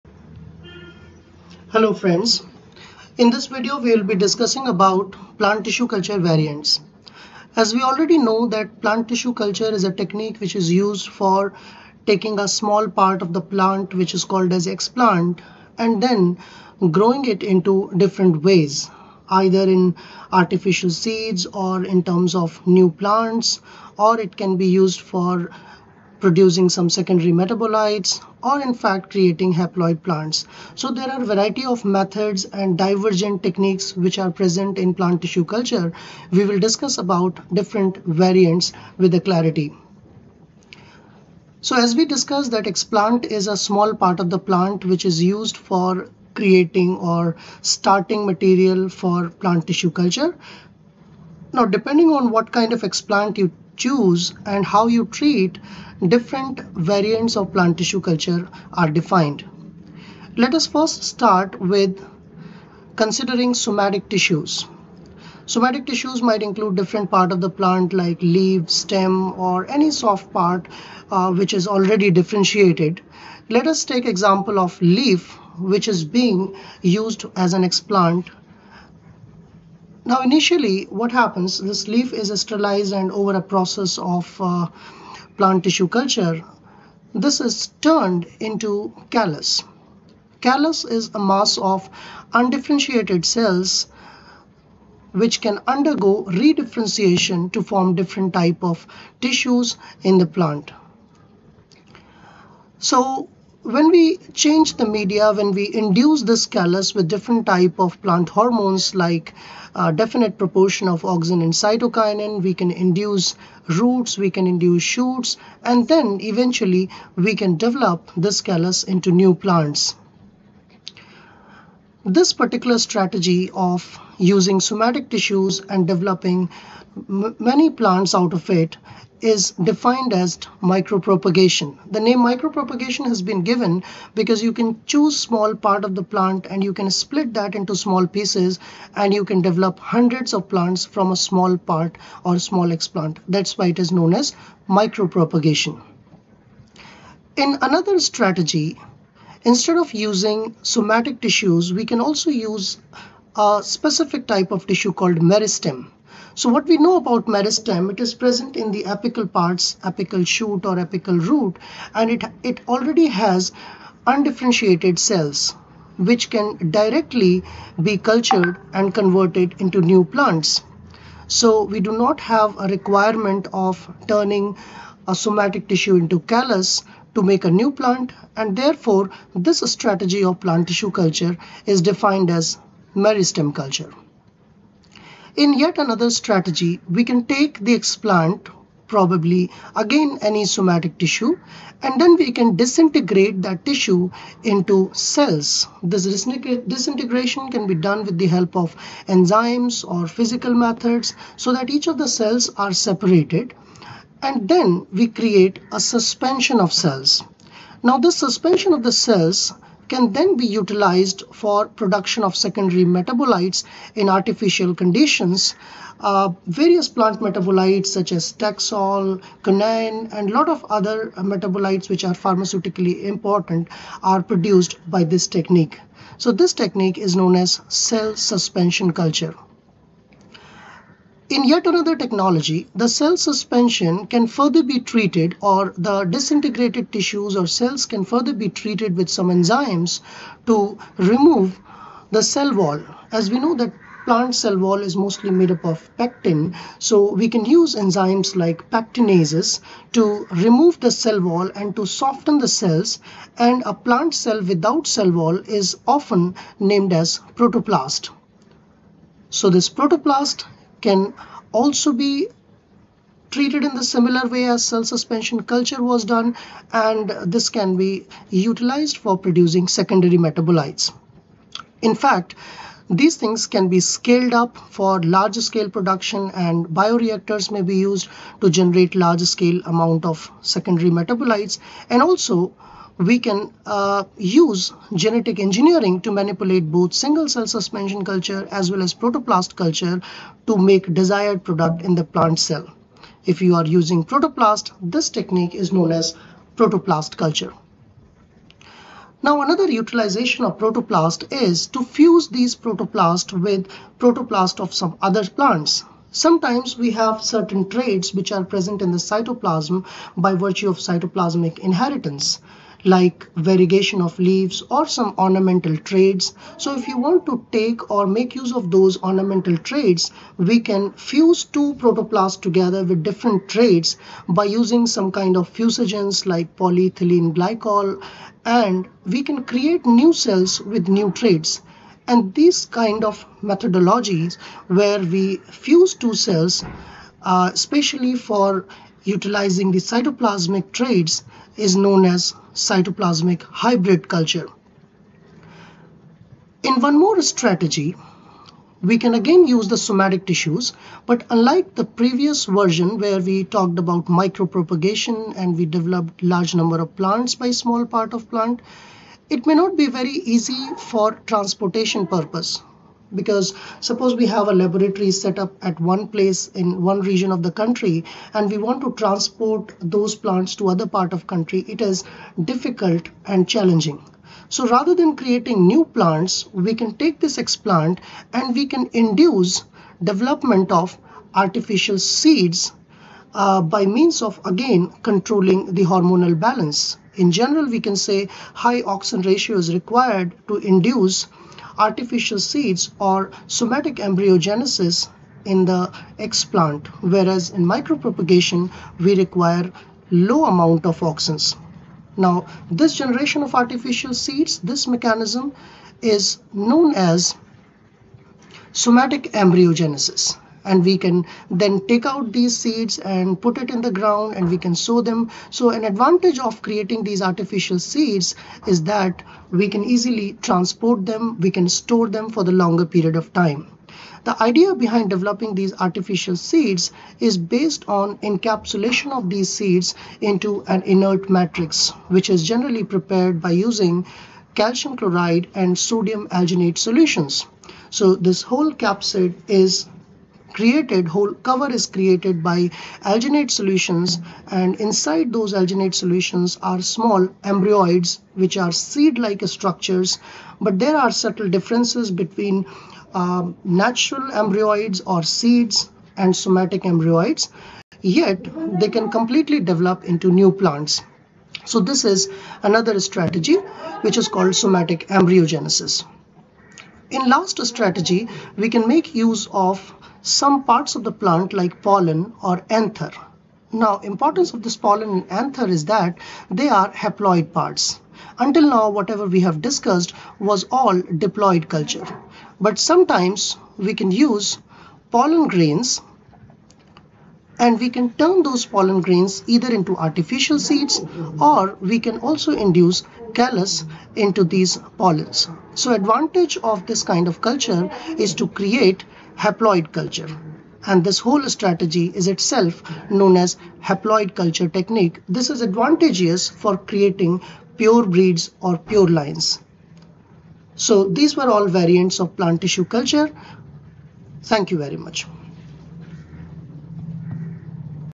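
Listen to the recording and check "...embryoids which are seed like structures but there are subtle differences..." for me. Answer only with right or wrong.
right.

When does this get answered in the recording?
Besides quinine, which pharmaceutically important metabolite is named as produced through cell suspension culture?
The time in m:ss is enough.
3:38.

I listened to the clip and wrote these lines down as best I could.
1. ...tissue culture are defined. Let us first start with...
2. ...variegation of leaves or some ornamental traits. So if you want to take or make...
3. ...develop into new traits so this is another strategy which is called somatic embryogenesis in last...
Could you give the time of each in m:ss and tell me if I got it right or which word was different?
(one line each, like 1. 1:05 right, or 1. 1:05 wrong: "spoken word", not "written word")
1. 0:57 right
2. 5:13 right
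3. 7:39 wrong: "plants", not "traits".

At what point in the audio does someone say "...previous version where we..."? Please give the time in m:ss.
5:51.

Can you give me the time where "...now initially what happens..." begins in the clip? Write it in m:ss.
1:20.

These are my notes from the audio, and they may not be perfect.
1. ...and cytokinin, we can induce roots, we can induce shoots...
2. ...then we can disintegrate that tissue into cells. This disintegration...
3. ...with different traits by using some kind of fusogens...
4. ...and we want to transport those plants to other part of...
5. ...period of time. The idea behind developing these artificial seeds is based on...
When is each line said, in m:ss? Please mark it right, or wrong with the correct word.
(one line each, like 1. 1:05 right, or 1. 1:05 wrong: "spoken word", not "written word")
1. 1:51 right
2. 3:12 right
3. 5:22 right
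4. 6:08 right
5. 7:02 right.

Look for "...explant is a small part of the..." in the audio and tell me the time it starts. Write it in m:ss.
0:42.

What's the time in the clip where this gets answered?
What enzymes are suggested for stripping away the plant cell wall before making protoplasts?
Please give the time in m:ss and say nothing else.
4:08.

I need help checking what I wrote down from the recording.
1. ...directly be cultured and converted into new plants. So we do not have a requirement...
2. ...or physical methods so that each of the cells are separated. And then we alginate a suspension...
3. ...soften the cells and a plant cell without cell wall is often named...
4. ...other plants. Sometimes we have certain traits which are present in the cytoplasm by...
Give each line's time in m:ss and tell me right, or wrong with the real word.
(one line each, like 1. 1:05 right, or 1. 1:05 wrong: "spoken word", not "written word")
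1. 2:46 right
2. 3:19 wrong: "create", not "alginate"
3. 4:11 right
4. 5:05 right.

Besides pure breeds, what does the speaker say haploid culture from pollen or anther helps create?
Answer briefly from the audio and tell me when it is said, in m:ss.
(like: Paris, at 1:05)
Pure lines, at 8:28.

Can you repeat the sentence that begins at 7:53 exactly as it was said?
Now importance of this pollen and anther is that they are haploid parts.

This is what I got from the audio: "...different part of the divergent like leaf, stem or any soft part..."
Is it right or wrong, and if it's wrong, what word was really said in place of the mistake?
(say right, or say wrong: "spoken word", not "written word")
wrong: "plant", not "divergent".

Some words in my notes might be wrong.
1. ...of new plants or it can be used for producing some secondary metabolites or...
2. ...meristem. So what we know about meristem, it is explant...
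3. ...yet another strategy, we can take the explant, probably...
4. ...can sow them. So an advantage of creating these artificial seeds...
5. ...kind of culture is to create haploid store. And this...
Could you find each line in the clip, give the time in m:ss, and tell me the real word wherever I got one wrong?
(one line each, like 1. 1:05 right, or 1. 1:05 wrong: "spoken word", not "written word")
1. 0:22 right
2. 2:35 wrong: "present", not "explant"
3. 3:05 right
4. 6:54 right
5. 8:17 wrong: "culture", not "store".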